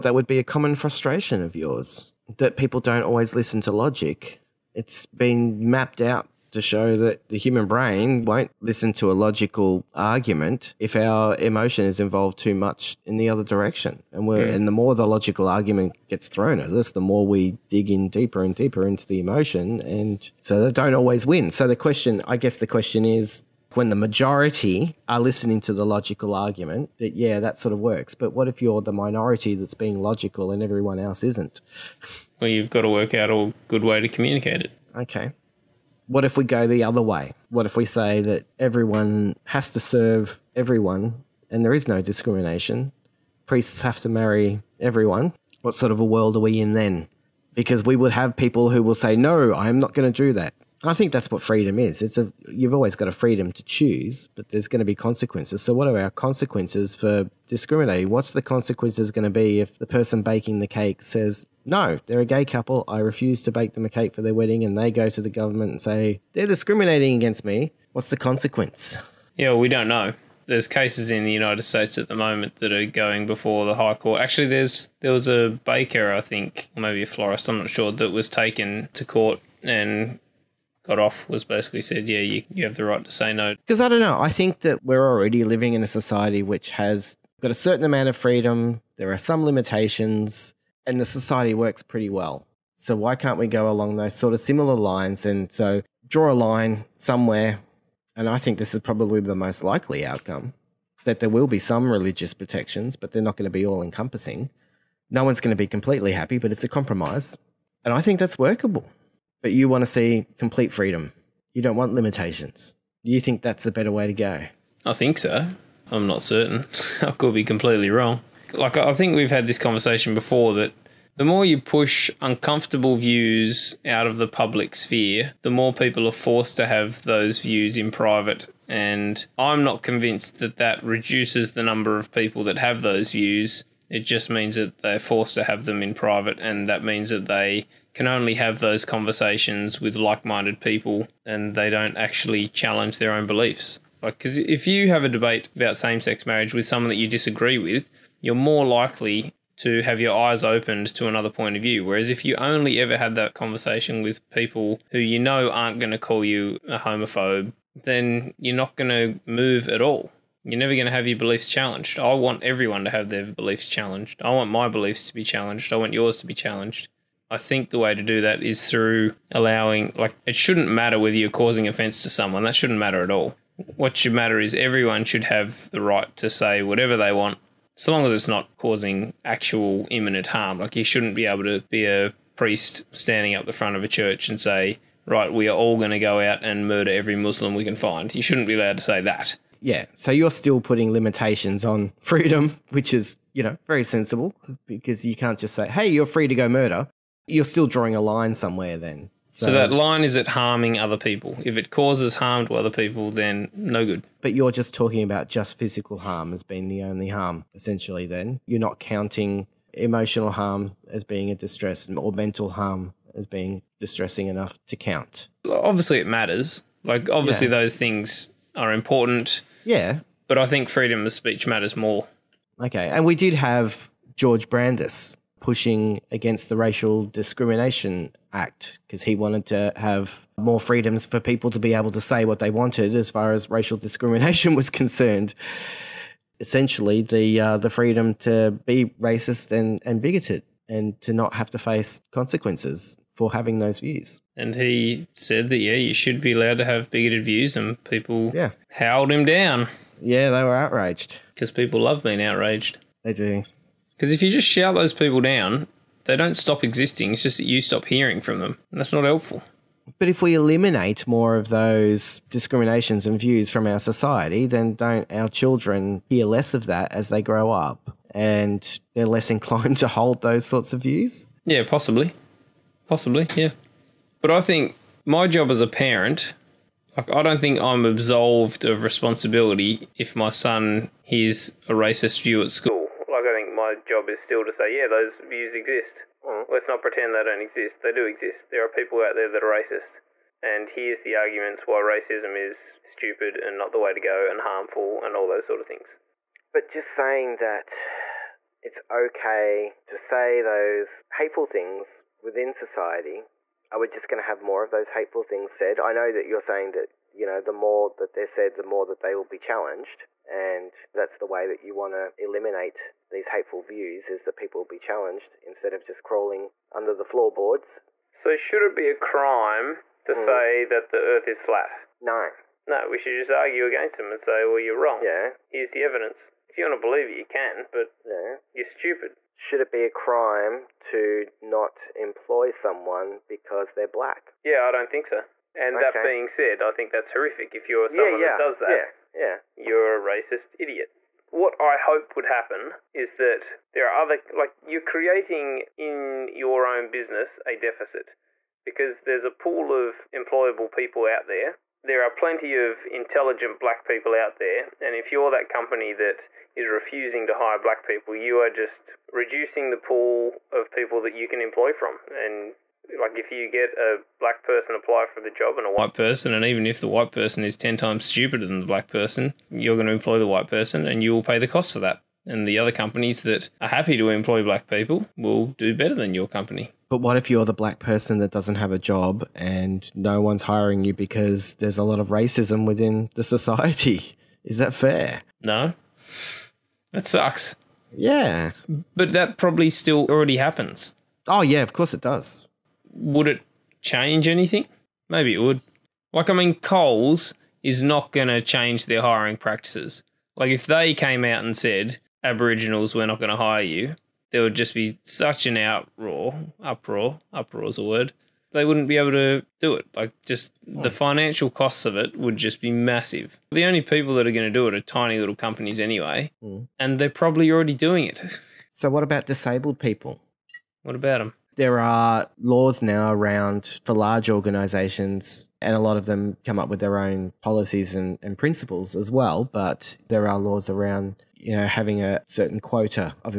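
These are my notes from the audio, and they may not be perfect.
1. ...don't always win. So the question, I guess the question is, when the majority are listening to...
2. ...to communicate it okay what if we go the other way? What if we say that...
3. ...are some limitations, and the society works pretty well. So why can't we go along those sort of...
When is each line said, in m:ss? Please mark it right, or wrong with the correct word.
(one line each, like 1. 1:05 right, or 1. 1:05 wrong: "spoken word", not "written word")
1. 0:20 right
2. 0:33 right
3. 1:29 right.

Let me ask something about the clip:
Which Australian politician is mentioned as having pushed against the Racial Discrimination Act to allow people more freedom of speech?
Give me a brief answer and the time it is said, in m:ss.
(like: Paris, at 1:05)
George Brandis, at 3:44.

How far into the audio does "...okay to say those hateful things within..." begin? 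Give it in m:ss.
4:58.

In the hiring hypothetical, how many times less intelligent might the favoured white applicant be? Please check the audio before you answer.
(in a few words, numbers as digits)
10.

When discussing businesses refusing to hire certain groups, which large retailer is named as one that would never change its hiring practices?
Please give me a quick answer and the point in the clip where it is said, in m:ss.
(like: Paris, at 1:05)
Coles, at 6:36.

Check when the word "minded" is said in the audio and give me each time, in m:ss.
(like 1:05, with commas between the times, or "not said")
2:20.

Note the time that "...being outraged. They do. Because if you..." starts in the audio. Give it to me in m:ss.
4:12.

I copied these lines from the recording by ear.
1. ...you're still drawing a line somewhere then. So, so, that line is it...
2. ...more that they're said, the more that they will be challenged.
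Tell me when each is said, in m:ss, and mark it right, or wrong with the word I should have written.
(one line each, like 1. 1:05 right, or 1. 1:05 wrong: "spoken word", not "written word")
1. 3:17 right
2. 5:07 right.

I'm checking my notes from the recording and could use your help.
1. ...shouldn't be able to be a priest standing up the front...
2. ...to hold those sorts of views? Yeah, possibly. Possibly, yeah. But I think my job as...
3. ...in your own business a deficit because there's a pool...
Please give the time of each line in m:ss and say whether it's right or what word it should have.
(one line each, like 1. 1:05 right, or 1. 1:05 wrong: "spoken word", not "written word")
1. 3:00 right
2. 4:29 right
3. 5:45 right.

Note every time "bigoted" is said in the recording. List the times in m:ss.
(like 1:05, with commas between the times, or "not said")
4:00, 4:06.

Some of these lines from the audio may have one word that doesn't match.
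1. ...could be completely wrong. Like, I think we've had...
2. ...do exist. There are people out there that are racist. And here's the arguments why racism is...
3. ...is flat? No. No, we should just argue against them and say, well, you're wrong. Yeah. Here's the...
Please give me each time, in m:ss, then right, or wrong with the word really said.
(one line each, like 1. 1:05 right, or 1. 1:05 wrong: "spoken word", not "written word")
1. 1:57 right
2. 4:47 right
3. 5:21 right.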